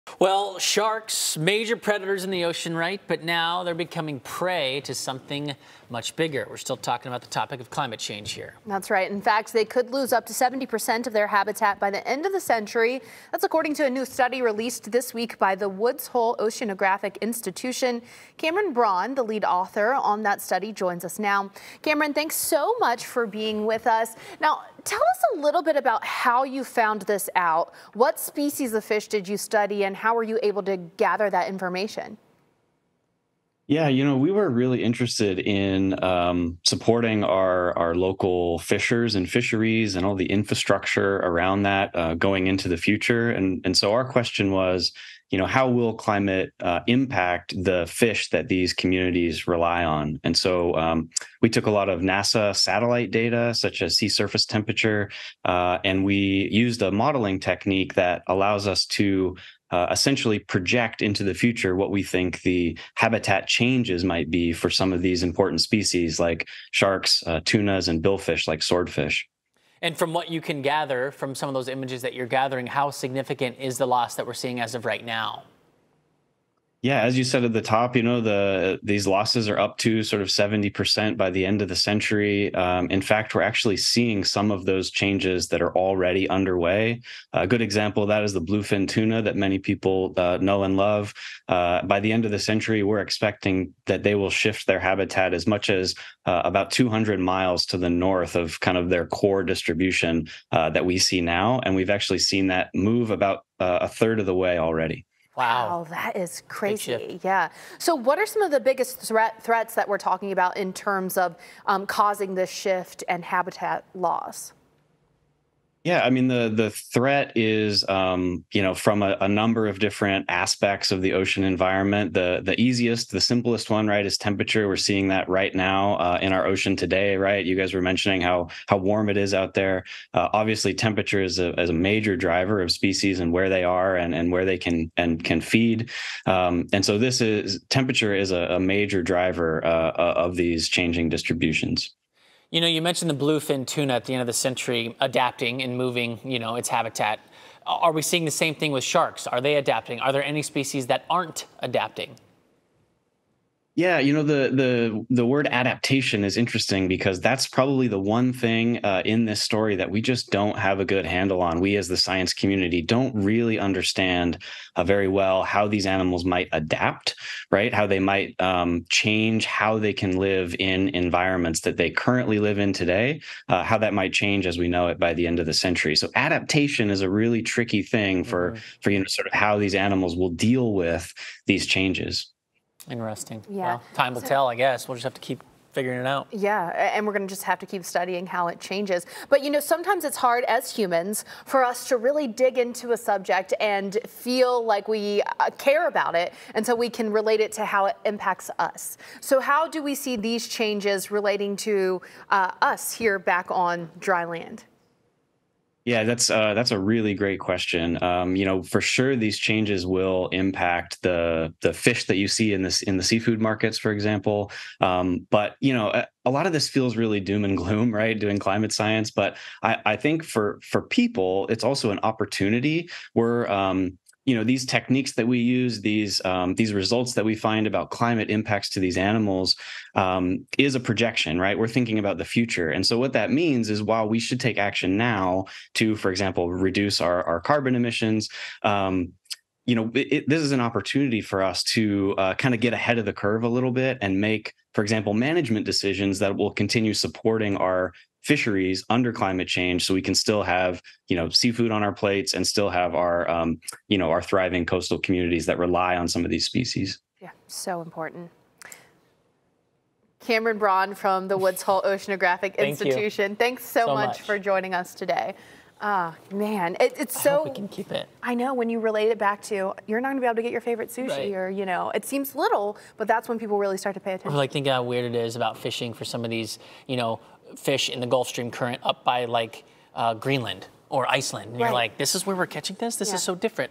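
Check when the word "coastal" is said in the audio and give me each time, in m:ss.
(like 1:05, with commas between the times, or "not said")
4:14.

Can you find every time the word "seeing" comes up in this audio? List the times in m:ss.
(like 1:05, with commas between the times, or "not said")
1:14, 1:23, 2:04, 2:28.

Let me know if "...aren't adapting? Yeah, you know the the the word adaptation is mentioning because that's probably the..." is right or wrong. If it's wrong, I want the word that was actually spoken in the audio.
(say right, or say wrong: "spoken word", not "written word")
wrong: "interesting", not "mentioning".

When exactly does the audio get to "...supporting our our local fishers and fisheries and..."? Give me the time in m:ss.
0:36.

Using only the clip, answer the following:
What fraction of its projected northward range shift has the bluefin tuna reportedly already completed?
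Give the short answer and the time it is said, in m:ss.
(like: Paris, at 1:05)
a third, at 1:43.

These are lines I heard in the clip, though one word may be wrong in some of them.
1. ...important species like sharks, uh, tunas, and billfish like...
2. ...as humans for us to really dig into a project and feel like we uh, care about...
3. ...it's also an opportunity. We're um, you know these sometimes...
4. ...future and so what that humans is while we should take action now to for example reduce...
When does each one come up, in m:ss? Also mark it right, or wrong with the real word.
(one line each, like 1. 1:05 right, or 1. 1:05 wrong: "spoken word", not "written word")
1. 1:05 right
2. 3:10 wrong: "subject", not "project"
3. 3:41 wrong: "techniques", not "sometimes"
4. 3:52 wrong: "means", not "humans".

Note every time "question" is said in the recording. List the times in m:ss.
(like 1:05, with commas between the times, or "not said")
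0:44, 3:27.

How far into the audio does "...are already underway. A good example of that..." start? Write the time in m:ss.
1:25.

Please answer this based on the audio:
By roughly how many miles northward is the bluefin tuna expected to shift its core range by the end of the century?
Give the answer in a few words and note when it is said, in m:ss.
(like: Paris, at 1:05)
200 miles, at 1:36.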